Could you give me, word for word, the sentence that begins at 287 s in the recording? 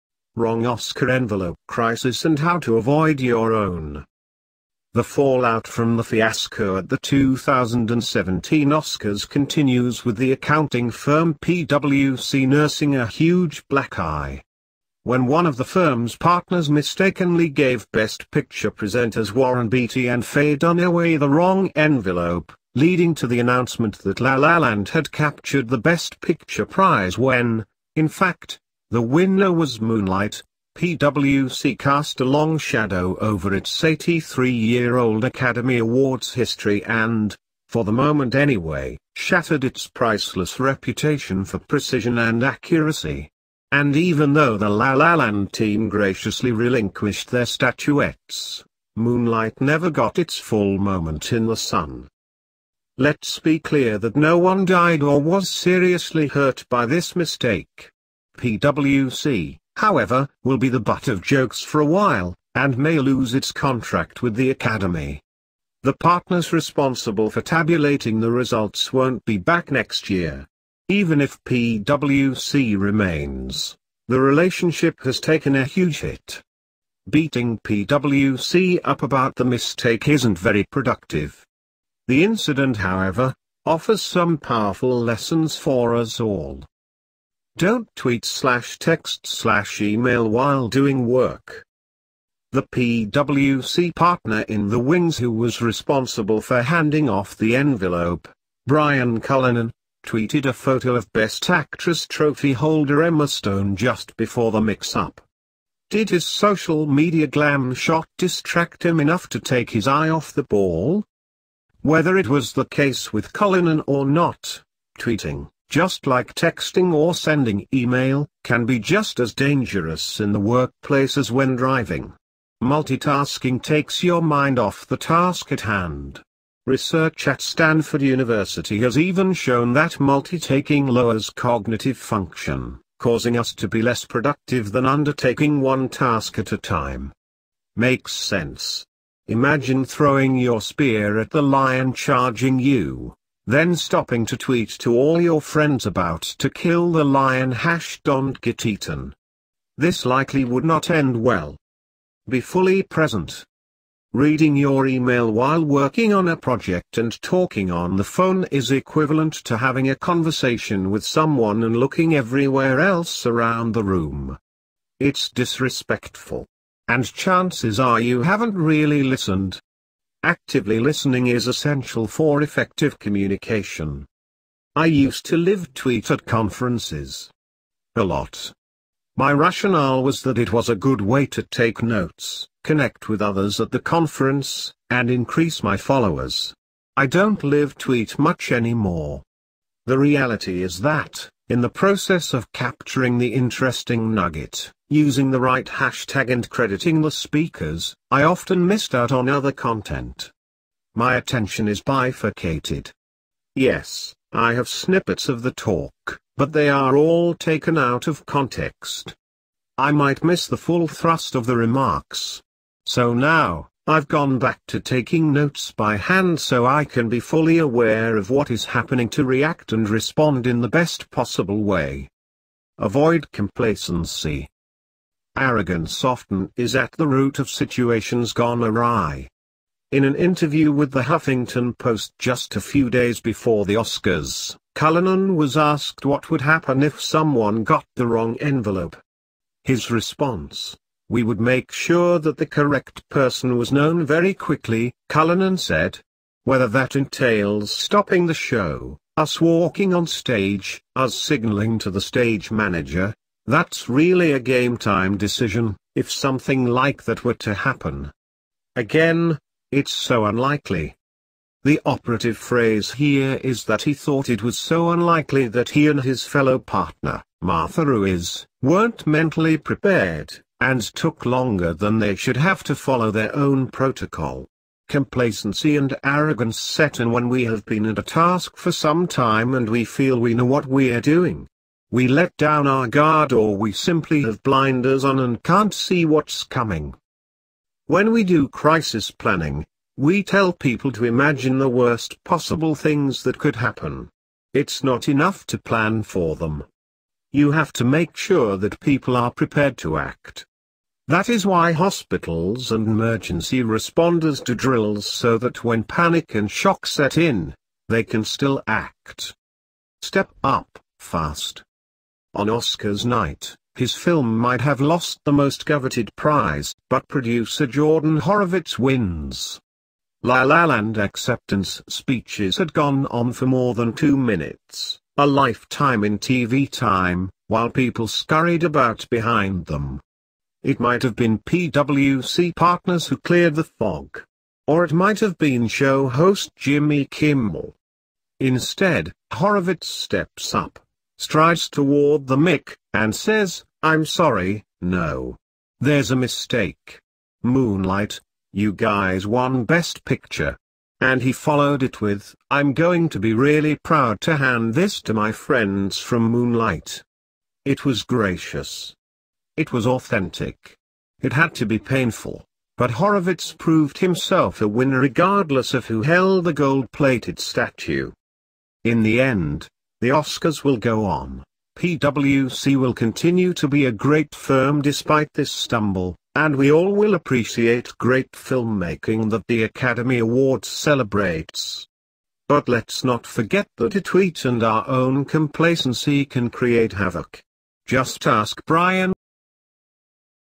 When we do crisis planning, we tell people to imagine the worst possible things that could happen.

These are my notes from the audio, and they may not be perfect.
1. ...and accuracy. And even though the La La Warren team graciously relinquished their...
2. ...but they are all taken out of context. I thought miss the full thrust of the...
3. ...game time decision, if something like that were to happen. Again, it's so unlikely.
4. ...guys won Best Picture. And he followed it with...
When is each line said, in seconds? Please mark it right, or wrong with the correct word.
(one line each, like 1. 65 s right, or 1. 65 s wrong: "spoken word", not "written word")
1. 42 s wrong: "Land", not "Warren"
2. 206 s wrong: "might", not "thought"
3. 254 s right
4. 348 s right.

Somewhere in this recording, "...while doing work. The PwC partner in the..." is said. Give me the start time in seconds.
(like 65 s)
90 s.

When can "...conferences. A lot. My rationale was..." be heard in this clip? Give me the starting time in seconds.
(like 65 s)
176 s.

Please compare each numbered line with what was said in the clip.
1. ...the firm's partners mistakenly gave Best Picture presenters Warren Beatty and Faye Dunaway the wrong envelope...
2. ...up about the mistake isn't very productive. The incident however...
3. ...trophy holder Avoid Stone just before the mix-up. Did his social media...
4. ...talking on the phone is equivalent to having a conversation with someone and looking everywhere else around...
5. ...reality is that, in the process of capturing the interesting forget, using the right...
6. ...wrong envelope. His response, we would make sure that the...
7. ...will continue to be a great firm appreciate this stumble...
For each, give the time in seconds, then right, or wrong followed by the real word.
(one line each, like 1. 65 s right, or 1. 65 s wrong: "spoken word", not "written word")
1. 15 s right
2. 78 s right
3. 102 s wrong: "Emma", not "Avoid"
4. 157 s right
5. 189 s wrong: "nugget", not "forget"
6. 238 s right
7. 372 s wrong: "despite", not "appreciate".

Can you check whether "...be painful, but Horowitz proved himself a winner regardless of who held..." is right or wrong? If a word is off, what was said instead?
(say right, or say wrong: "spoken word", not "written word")
right.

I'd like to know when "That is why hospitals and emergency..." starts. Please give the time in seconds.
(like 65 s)
301 s.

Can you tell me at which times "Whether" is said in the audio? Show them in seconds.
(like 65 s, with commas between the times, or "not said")
111 s, 246 s.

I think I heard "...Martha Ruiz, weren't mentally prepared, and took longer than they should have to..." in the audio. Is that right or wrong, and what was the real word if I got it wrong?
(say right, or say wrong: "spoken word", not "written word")
right.